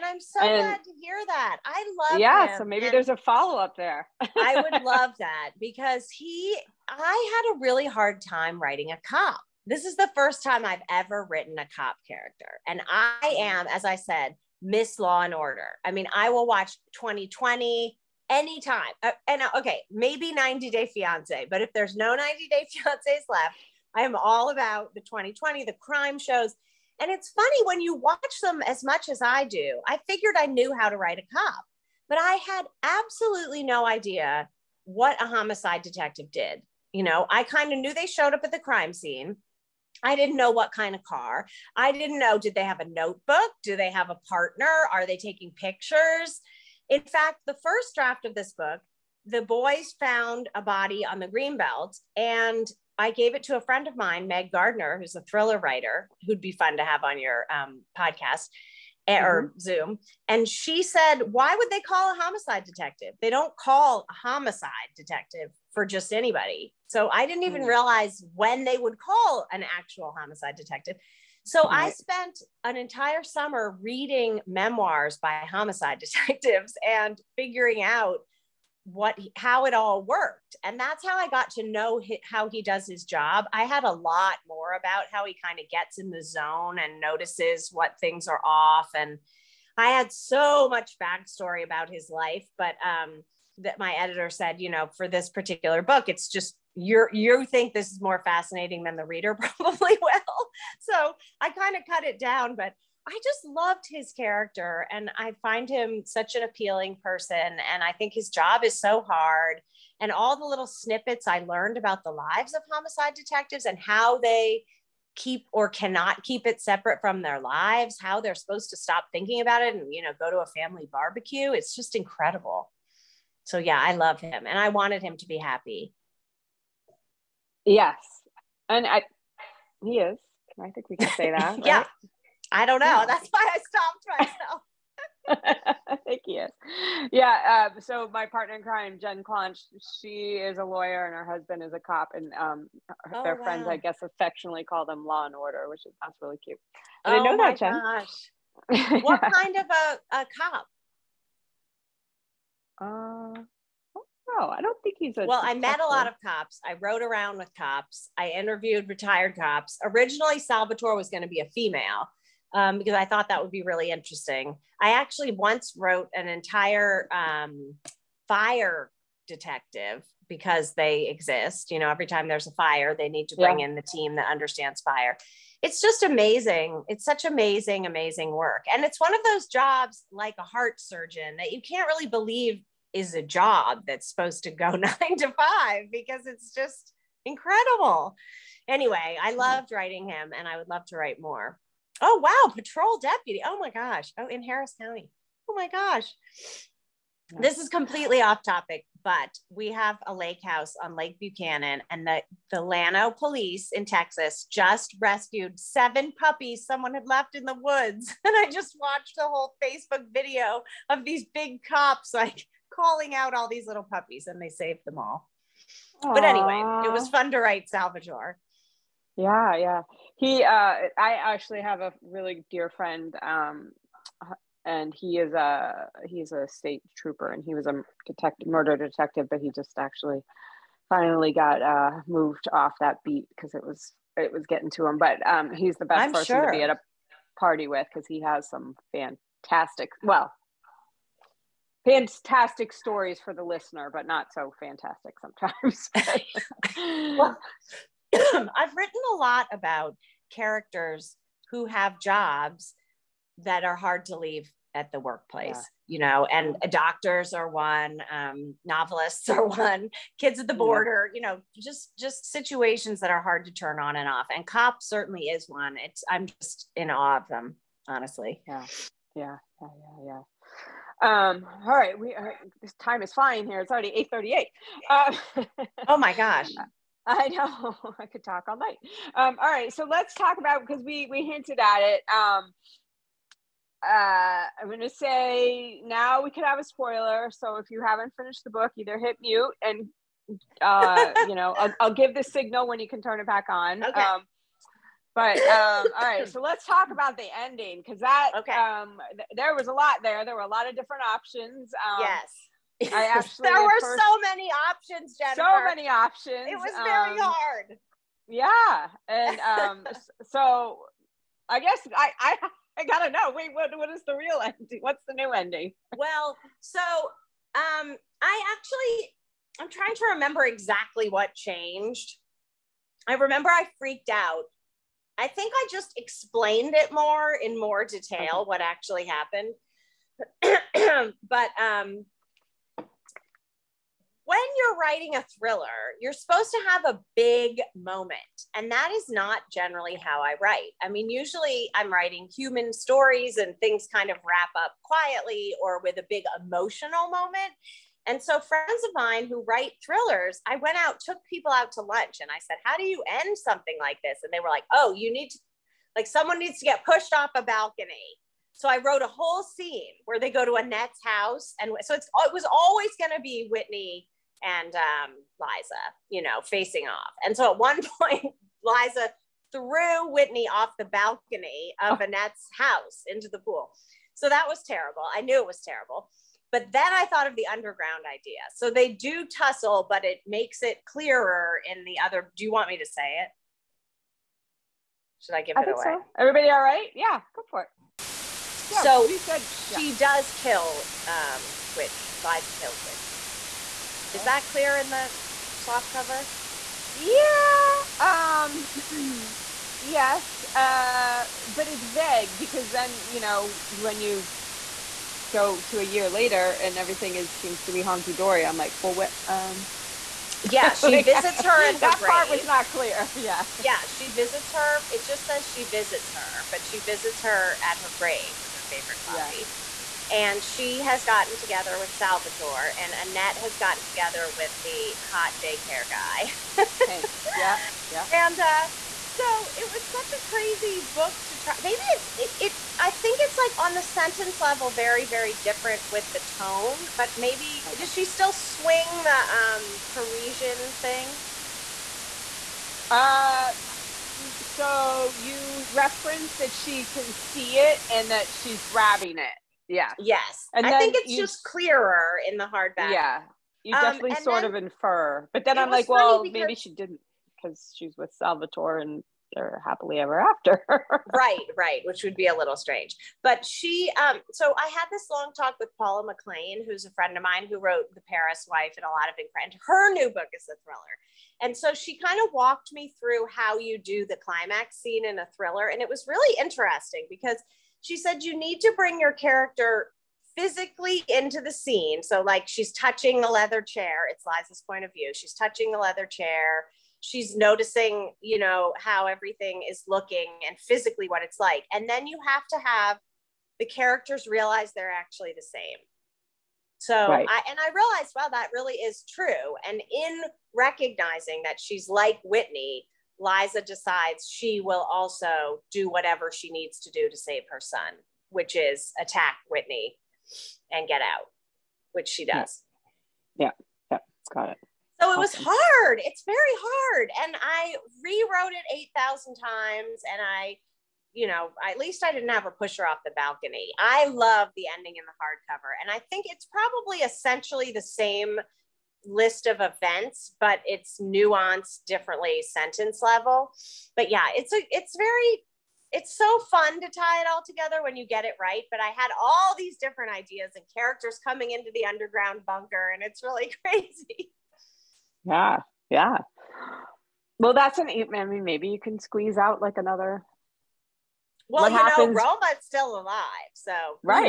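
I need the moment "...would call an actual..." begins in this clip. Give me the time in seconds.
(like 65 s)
68 s.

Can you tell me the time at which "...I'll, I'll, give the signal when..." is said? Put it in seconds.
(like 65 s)
291 s.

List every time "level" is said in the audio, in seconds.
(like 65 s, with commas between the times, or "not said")
434 s, 533 s.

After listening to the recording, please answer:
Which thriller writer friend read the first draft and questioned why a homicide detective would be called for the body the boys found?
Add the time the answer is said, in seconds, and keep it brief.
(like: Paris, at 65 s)
Meg Gardiner, at 54 s.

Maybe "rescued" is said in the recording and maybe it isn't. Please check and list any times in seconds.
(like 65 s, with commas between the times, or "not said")
204 s.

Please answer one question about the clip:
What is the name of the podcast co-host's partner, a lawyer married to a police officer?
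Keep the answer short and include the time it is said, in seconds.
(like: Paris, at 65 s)
Jen Clonch, at 138 s.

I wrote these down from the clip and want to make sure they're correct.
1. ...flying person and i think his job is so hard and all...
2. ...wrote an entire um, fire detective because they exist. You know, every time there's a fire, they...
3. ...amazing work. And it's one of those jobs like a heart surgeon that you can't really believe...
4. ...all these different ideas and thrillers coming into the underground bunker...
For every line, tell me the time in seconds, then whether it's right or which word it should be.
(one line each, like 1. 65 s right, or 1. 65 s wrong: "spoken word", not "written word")
1. 106 s wrong: "appealing", not "flying"
2. 165 s right
3. 177 s right
4. 539 s wrong: "characters", not "thrillers".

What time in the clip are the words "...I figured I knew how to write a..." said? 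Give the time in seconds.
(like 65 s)
29 s.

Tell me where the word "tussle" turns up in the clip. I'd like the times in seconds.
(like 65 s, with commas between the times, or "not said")
379 s.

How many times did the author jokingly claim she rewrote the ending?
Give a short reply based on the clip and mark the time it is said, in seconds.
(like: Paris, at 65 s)
8,000, at 518 s.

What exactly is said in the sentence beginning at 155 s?
Well, I met a lot of cops.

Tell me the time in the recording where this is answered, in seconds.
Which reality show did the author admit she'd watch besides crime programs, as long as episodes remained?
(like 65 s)
20 s.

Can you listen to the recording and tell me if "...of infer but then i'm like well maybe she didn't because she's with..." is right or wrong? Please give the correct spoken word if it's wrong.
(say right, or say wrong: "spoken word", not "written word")
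right.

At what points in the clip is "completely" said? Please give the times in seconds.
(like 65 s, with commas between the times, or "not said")
197 s.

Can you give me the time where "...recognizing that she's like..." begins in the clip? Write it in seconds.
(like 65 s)
500 s.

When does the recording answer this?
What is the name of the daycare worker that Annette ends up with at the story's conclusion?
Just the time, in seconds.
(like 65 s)
426 s.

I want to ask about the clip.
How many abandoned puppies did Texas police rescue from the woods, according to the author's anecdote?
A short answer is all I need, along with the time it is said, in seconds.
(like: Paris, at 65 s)
7, at 205 s.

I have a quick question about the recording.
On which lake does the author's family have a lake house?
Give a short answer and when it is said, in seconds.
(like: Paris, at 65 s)
Lake Buchanan, at 200 s.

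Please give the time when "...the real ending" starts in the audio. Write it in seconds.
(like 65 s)
314 s.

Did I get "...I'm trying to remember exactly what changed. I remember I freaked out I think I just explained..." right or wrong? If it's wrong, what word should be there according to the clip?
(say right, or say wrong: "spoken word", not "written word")
right.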